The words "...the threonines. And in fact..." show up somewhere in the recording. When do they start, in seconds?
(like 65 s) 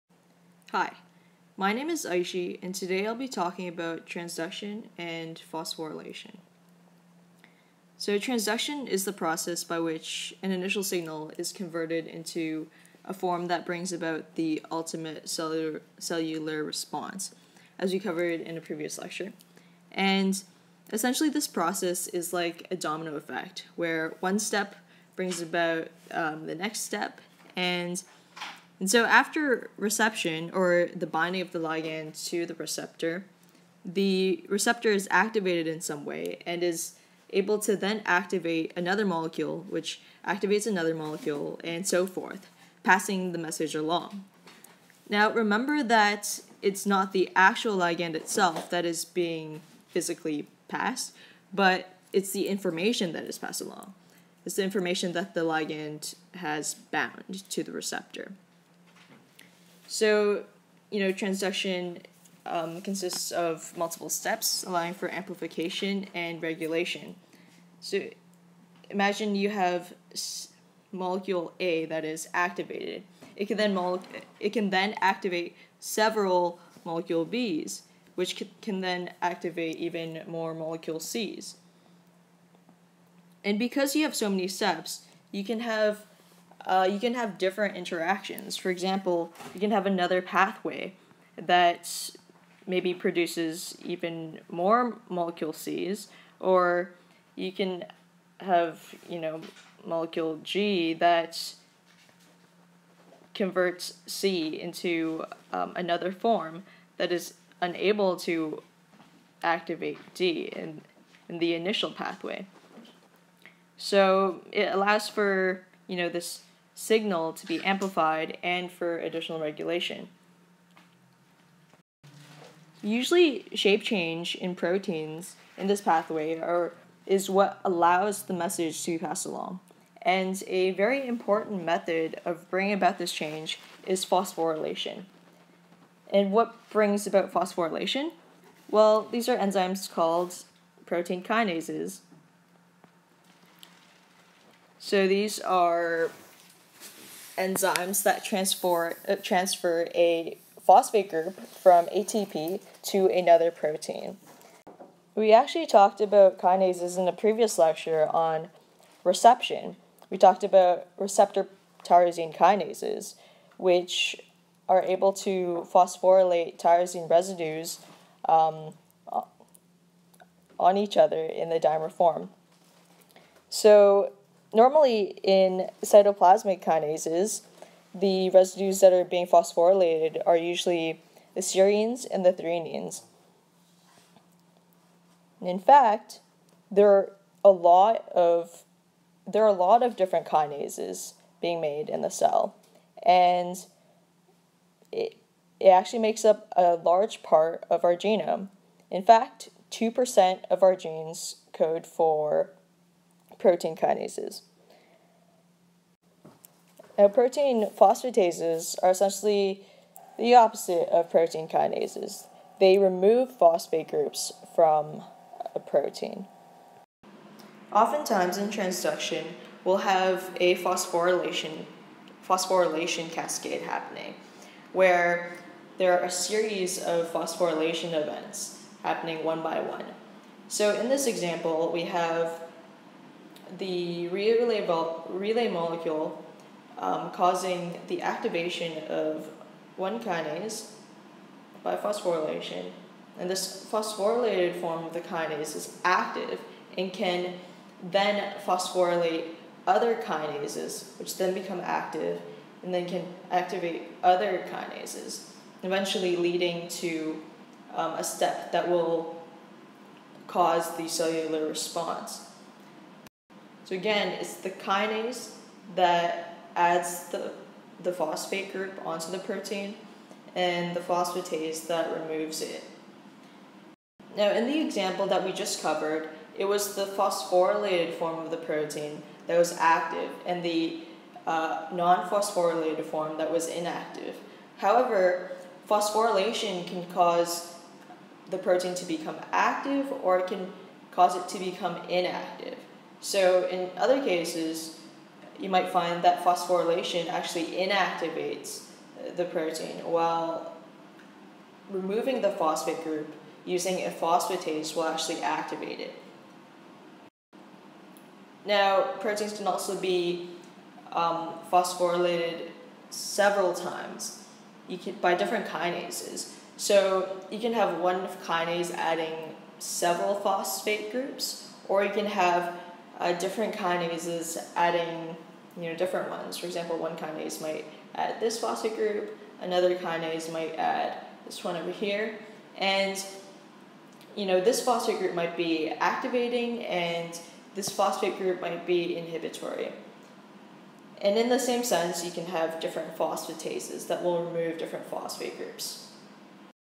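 182 s.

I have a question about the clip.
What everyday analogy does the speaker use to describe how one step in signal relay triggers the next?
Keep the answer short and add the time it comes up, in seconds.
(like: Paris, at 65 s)
domino effect, at 22 s.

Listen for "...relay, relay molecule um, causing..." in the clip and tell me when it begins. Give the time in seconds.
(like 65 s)
234 s.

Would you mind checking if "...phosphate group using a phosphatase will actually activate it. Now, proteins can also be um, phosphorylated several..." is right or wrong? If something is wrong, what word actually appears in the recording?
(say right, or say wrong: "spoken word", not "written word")
right.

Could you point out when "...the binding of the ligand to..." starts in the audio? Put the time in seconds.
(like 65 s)
30 s.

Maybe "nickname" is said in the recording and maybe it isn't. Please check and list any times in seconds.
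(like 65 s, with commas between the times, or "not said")
not said.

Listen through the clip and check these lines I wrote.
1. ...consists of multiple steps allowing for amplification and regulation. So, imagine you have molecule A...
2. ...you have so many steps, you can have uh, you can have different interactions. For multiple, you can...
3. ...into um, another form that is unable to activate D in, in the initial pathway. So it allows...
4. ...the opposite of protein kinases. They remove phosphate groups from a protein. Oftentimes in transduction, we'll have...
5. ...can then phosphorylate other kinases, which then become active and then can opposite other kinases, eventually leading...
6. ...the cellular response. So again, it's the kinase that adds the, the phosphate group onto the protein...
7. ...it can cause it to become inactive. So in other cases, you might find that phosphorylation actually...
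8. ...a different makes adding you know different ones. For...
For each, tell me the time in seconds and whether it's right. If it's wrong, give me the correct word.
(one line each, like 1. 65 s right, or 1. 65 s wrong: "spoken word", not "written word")
1. 62 s right
2. 83 s wrong: "example", not "multiple"
3. 104 s right
4. 210 s right
5. 246 s wrong: "activate", not "opposite"
6. 260 s right
7. 290 s right
8. 322 s wrong: "kinases", not "makes".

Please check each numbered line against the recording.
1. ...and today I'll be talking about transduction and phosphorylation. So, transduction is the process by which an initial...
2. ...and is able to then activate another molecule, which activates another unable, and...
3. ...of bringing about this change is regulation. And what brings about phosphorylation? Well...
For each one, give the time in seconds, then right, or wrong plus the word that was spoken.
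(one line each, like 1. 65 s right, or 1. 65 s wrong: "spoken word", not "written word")
1. 2 s right
2. 36 s wrong: "molecule", not "unable"
3. 132 s wrong: "phosphorylation", not "regulation".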